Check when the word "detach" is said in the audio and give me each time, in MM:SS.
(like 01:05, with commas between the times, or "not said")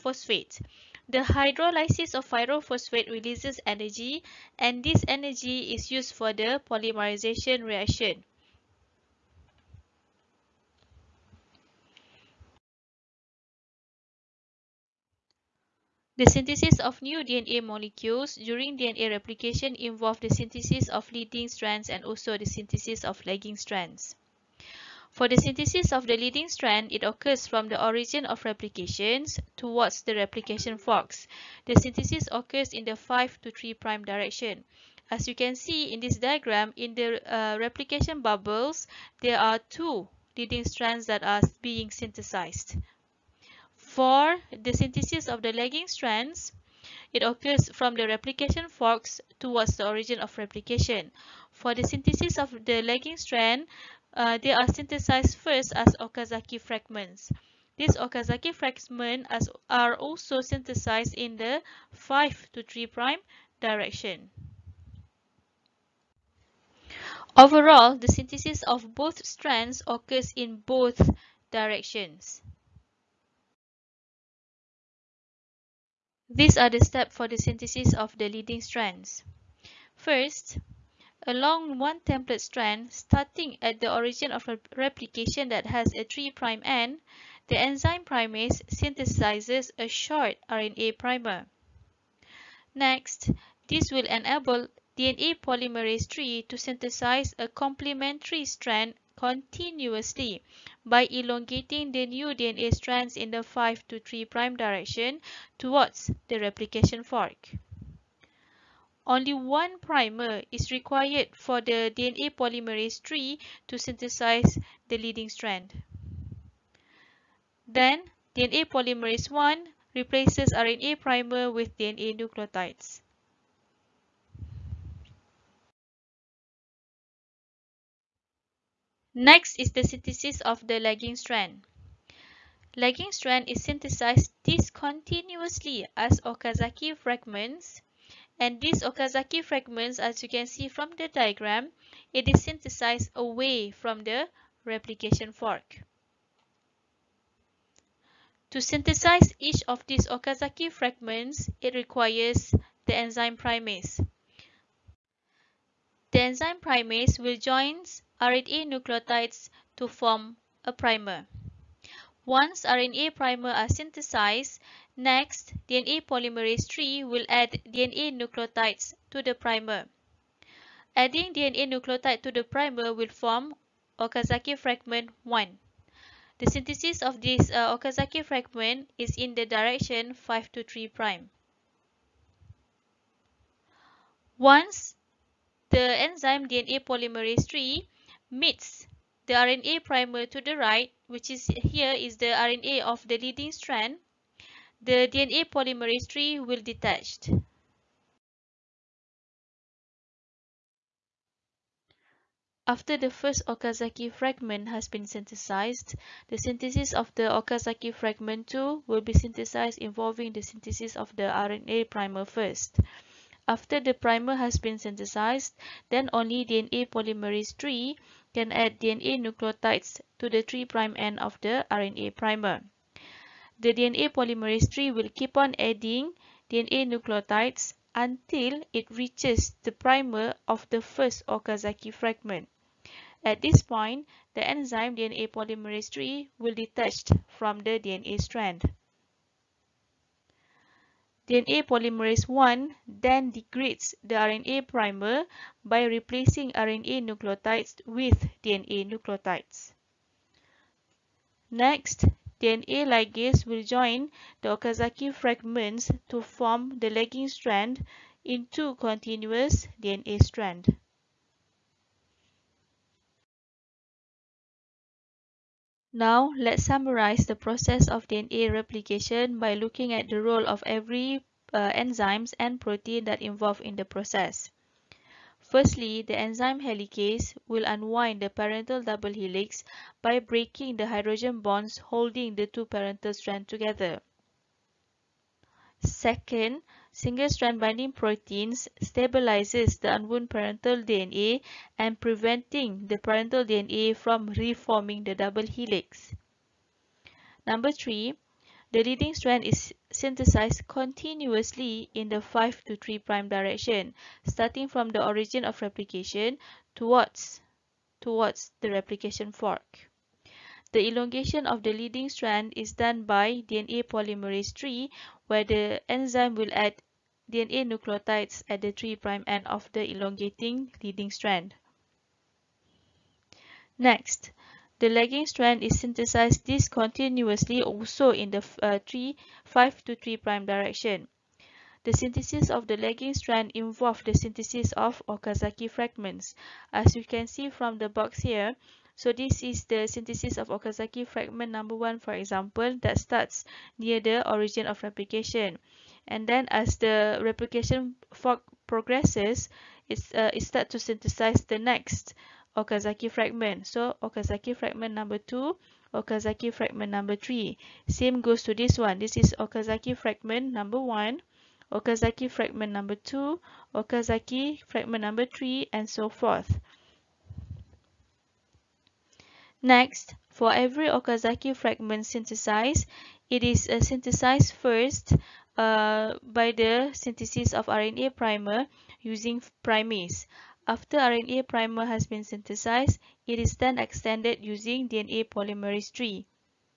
03:16, 03:56.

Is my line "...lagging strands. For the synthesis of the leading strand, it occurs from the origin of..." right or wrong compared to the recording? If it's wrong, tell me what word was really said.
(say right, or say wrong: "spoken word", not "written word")
right.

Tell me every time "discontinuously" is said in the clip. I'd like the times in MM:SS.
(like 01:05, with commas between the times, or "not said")
02:14, 05:26.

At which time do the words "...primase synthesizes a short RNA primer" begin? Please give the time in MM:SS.
01:28.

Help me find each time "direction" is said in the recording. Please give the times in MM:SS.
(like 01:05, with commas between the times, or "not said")
00:34, 01:03, 01:11, 01:44, 02:59, 05:03, 05:30.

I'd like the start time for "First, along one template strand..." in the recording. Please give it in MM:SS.
01:19.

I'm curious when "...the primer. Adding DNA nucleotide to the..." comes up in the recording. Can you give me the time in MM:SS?
02:49.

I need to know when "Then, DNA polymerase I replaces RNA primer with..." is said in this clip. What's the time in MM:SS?
01:57.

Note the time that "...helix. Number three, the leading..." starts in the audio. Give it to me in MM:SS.
04:55.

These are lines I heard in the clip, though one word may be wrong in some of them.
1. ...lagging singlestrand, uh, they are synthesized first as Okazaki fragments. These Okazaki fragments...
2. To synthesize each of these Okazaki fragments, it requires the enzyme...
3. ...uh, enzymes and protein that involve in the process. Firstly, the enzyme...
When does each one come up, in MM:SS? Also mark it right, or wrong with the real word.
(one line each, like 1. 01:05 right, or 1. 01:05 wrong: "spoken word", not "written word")
1. 00:52 wrong: "strand", not "singlestrand"
2. 02:28 right
3. 04:31 right.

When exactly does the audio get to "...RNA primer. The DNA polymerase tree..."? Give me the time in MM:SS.
03:41.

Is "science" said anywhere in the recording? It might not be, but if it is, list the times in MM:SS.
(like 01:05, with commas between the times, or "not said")
not said.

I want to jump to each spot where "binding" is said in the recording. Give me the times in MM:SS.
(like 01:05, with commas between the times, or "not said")
04:47.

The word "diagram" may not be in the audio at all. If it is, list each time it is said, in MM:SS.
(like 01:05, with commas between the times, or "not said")
00:36, 02:21.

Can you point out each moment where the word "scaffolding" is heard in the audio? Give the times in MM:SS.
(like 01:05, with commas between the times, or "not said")
not said.